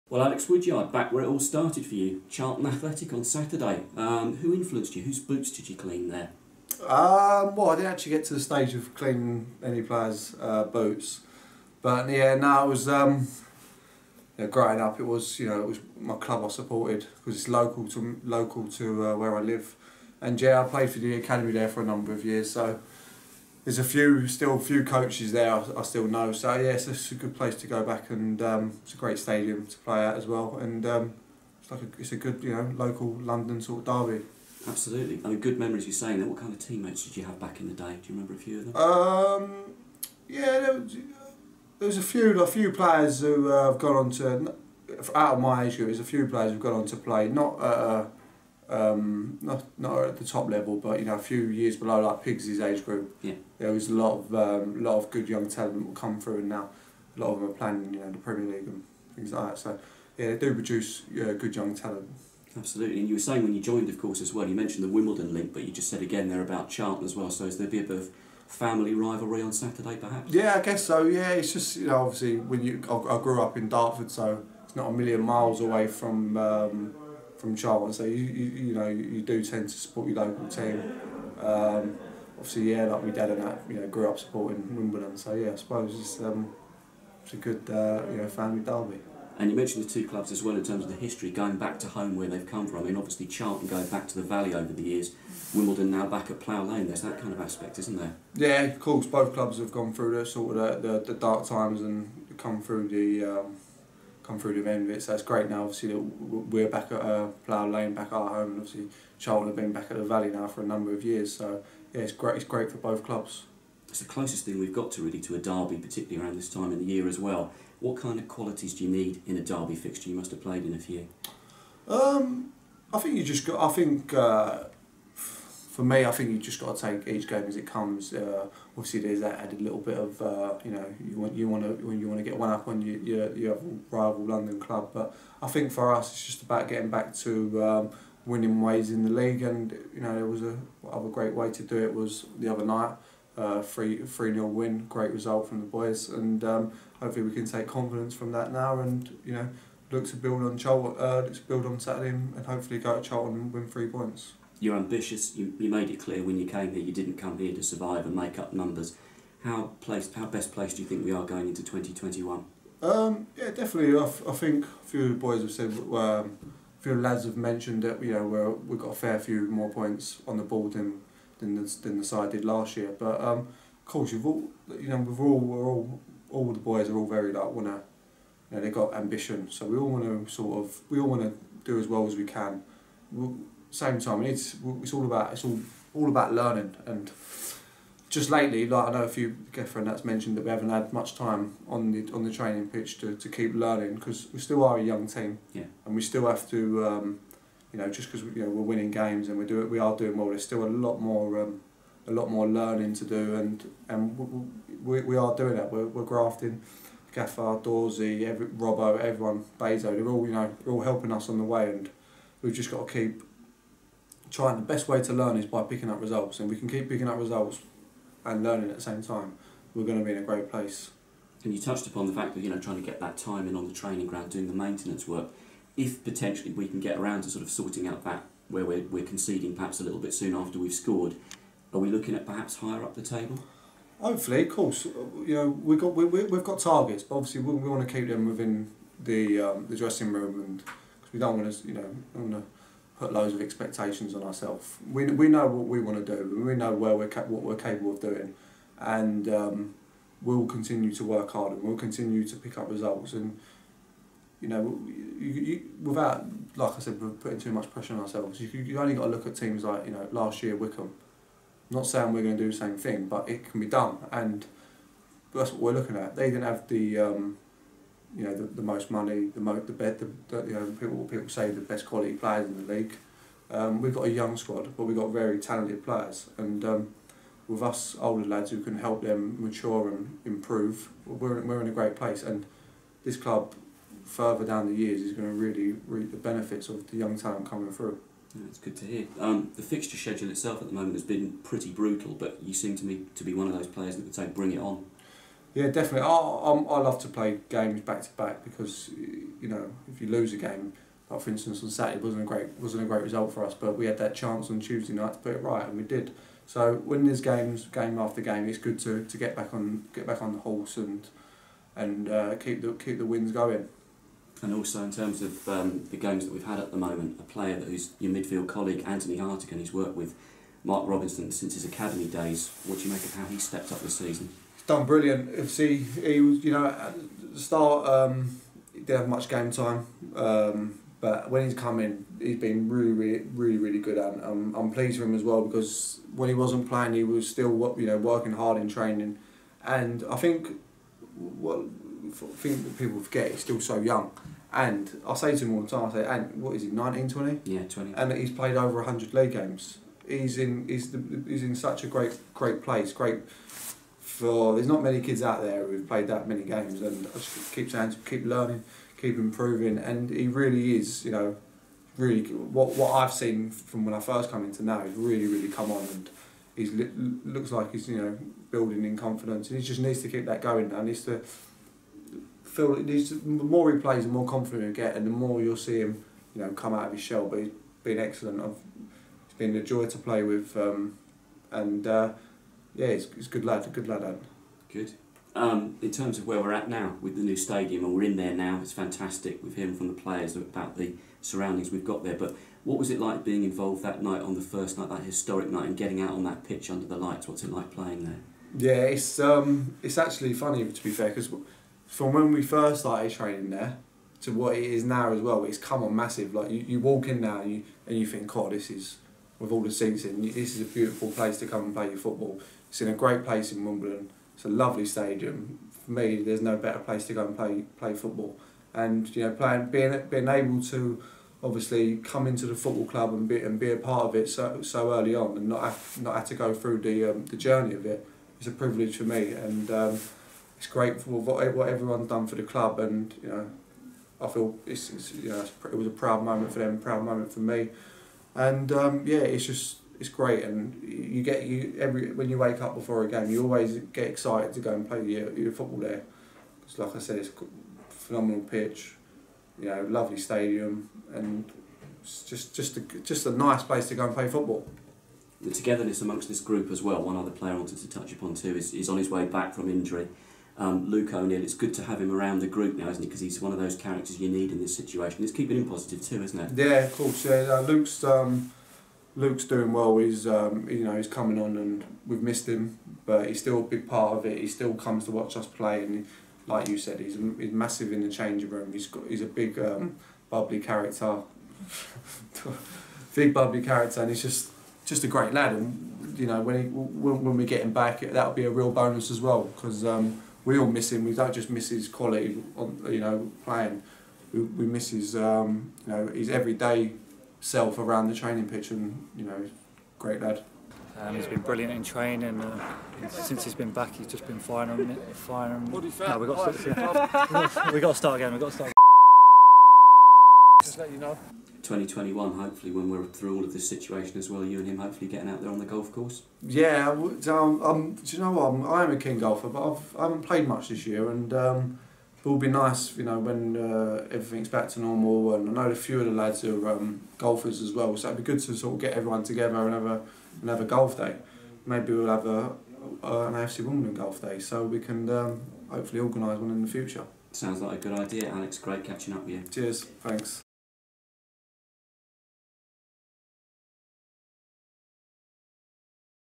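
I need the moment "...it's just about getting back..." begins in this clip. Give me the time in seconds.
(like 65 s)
136 s.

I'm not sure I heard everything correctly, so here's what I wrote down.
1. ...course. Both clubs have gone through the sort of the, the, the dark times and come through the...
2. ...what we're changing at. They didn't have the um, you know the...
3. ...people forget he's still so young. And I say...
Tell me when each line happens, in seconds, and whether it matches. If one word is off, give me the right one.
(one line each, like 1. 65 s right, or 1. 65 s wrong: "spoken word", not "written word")
1. 98 s right
2. 265 s wrong: "looking", not "changing"
3. 342 s right.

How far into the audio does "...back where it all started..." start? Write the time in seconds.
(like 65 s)
0 s.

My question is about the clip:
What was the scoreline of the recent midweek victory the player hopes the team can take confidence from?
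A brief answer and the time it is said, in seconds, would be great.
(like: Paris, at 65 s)
3-0, at 143 s.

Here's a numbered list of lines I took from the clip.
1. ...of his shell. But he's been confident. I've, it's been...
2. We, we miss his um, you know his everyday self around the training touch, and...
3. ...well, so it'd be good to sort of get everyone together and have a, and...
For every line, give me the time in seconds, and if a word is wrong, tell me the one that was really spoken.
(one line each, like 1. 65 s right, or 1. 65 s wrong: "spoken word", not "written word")
1. 376 s wrong: "excellent", not "confident"
2. 494 s wrong: "pitch", not "touch"
3. 527 s right.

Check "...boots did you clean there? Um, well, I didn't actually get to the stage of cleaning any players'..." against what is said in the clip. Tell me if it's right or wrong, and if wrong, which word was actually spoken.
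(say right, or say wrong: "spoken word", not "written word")
right.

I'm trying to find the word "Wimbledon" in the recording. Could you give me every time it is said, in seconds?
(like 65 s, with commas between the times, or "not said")
64 s, 84 s, 95 s, 413 s, 533 s.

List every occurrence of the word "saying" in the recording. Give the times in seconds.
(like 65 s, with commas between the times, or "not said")
35 s, 63 s, 261 s, 357 s.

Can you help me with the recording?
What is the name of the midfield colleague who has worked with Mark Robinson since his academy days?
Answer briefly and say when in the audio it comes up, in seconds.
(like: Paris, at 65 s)
Anthony Hartigan, at 318 s.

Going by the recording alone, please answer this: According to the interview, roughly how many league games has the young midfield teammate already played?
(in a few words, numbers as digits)
100.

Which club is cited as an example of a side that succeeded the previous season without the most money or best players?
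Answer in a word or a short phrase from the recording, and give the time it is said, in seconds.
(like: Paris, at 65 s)
Wycombe, at 260 s.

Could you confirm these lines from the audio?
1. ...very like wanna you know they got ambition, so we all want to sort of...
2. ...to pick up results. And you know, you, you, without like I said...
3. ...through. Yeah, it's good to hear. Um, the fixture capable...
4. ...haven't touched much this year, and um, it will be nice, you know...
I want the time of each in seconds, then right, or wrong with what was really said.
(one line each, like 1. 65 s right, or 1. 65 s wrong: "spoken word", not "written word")
1. 177 s right
2. 252 s right
3. 287 s wrong: "schedule", not "capable"
4. 520 s wrong: "played", not "touched".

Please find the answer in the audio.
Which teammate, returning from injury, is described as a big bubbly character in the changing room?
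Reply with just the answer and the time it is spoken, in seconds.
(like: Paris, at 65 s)
Luke O'Neill, at 460 s.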